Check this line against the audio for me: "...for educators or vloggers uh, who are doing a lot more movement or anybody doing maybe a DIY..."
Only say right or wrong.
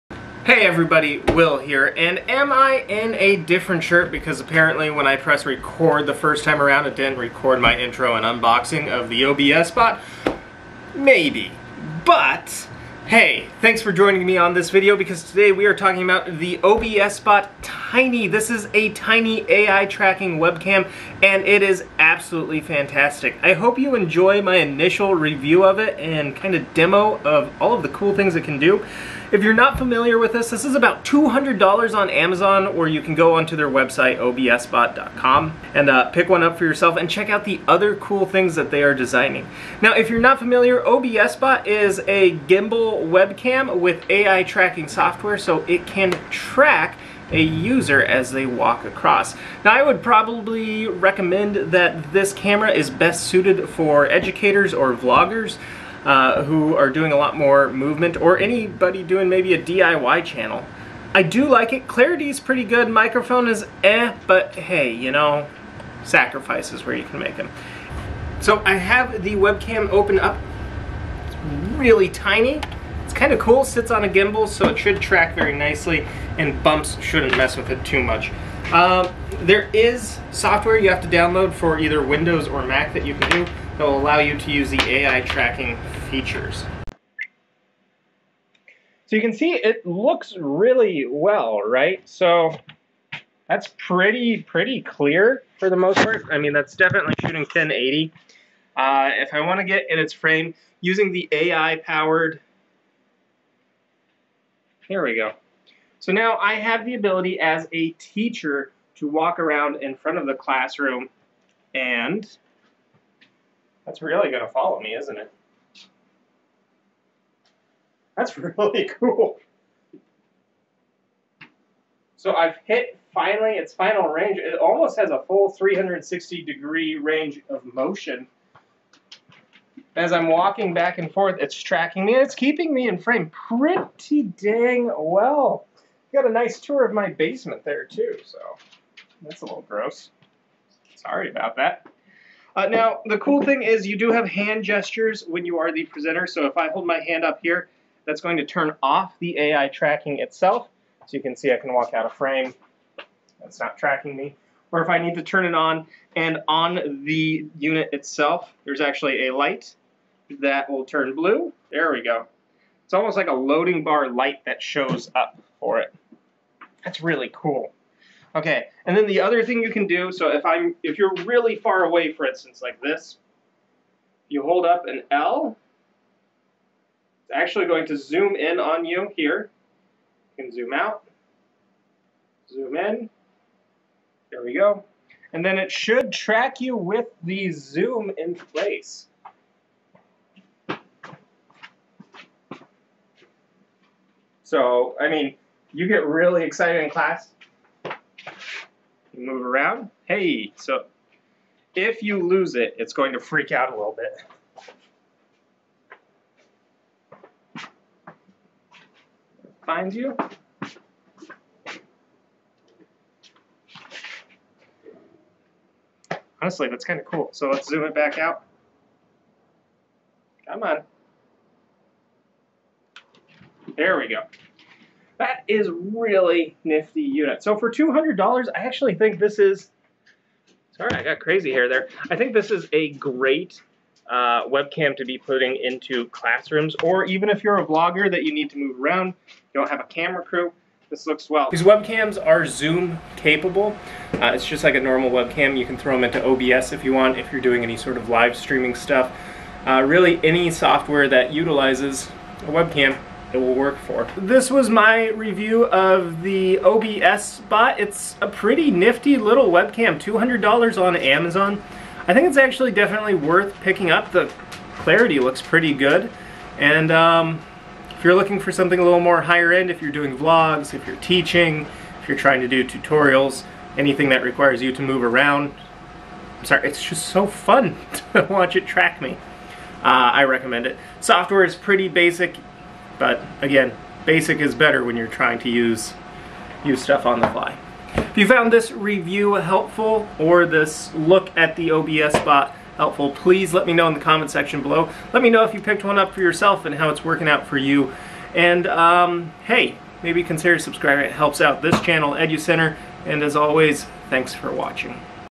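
right.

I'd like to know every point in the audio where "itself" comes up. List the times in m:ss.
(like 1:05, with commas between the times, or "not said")
2:30, 2:37.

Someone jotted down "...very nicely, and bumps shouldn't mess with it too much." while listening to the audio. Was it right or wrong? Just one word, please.
right.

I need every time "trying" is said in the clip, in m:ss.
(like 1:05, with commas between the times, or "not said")
4:32, 4:45.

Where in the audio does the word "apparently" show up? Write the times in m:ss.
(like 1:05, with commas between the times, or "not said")
0:04.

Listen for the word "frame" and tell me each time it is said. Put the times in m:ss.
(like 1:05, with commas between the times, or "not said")
1:40, 2:12, 2:32.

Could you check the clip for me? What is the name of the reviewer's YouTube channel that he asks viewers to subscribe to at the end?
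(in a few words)
EduCenter.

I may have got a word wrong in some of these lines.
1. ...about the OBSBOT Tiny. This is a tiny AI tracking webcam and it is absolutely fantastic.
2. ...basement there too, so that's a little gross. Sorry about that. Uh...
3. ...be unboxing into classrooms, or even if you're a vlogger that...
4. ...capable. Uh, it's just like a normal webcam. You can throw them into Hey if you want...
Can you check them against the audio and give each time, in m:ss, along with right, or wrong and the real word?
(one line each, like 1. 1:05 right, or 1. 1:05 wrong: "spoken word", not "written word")
1. 0:16 right
2. 2:17 right
3. 3:55 wrong: "putting", not "unboxing"
4. 4:03 wrong: "OBS", not "Hey".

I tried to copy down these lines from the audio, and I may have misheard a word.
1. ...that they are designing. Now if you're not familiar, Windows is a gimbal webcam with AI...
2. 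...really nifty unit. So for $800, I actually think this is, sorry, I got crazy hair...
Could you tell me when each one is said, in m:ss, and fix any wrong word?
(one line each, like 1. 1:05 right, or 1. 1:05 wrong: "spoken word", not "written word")
1. 0:38 wrong: "OBSBot", not "Windows"
2. 3:45 wrong: "200", not "800".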